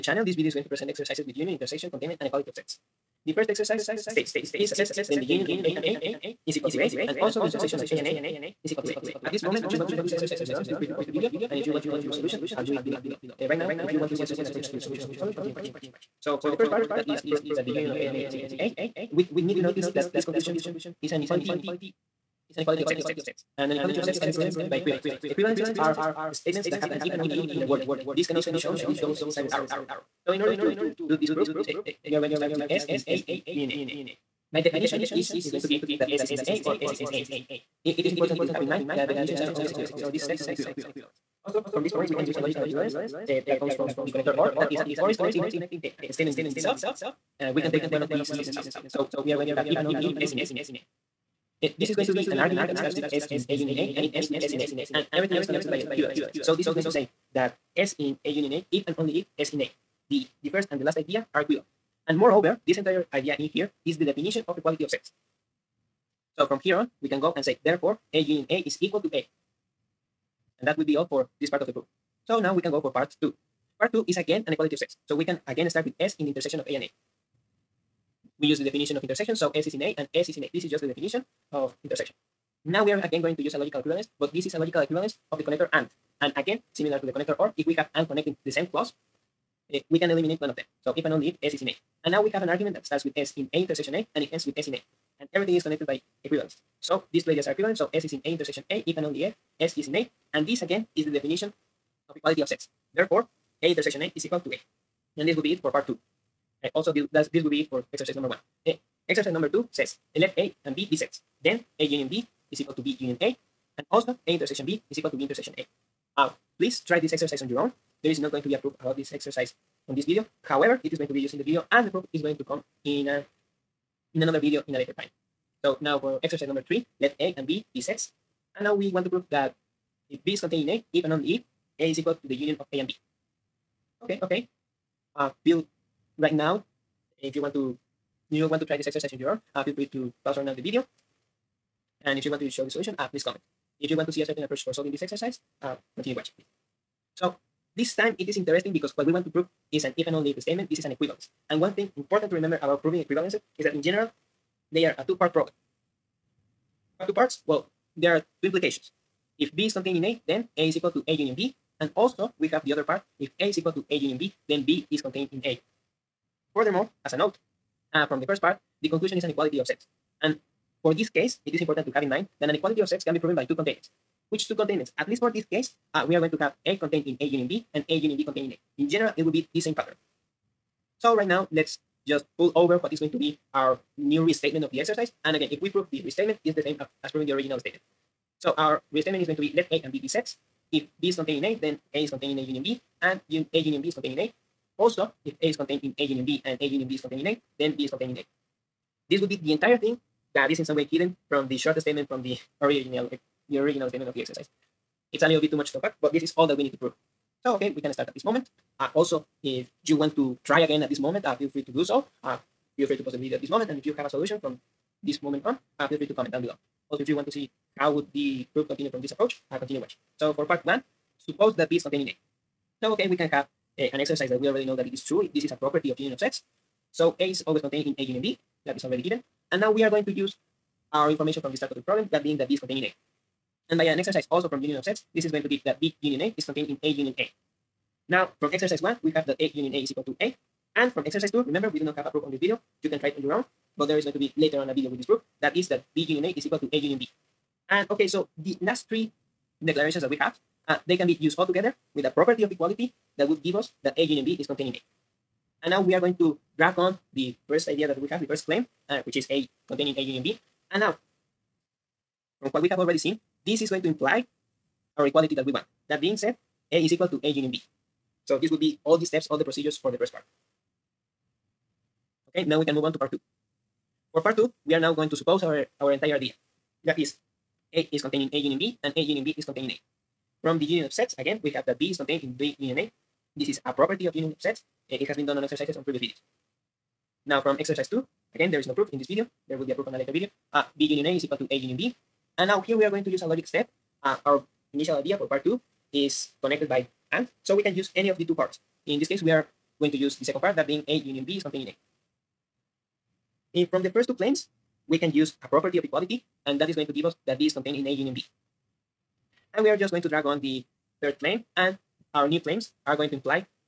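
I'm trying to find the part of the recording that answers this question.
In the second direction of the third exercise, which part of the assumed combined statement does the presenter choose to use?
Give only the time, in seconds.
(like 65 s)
300 s.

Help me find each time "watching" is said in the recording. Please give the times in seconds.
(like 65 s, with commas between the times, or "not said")
15 s, 146 s, 219 s.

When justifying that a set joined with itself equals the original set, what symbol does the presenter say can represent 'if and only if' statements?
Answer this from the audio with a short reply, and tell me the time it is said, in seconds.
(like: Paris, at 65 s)
double-sided arrow, at 28 s.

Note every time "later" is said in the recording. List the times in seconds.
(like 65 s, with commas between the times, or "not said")
124 s, 244 s, 289 s.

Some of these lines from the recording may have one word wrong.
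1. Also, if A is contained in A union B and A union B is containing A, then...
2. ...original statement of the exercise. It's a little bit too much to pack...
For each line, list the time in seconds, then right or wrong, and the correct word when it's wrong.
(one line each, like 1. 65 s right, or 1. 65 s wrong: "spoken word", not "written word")
1. 194 s right
2. 203 s right.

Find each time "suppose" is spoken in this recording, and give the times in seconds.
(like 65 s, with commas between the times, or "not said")
221 s, 275 s.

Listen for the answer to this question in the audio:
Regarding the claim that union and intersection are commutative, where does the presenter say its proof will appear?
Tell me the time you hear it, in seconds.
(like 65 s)
124 s.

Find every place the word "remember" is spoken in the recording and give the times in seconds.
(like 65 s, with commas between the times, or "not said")
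152 s, 241 s.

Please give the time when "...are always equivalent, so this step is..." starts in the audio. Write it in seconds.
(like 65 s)
39 s.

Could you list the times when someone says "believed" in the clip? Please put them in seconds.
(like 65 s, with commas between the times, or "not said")
not said.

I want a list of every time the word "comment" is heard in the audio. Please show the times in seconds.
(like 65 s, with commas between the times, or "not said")
11 s, 143 s, 216 s.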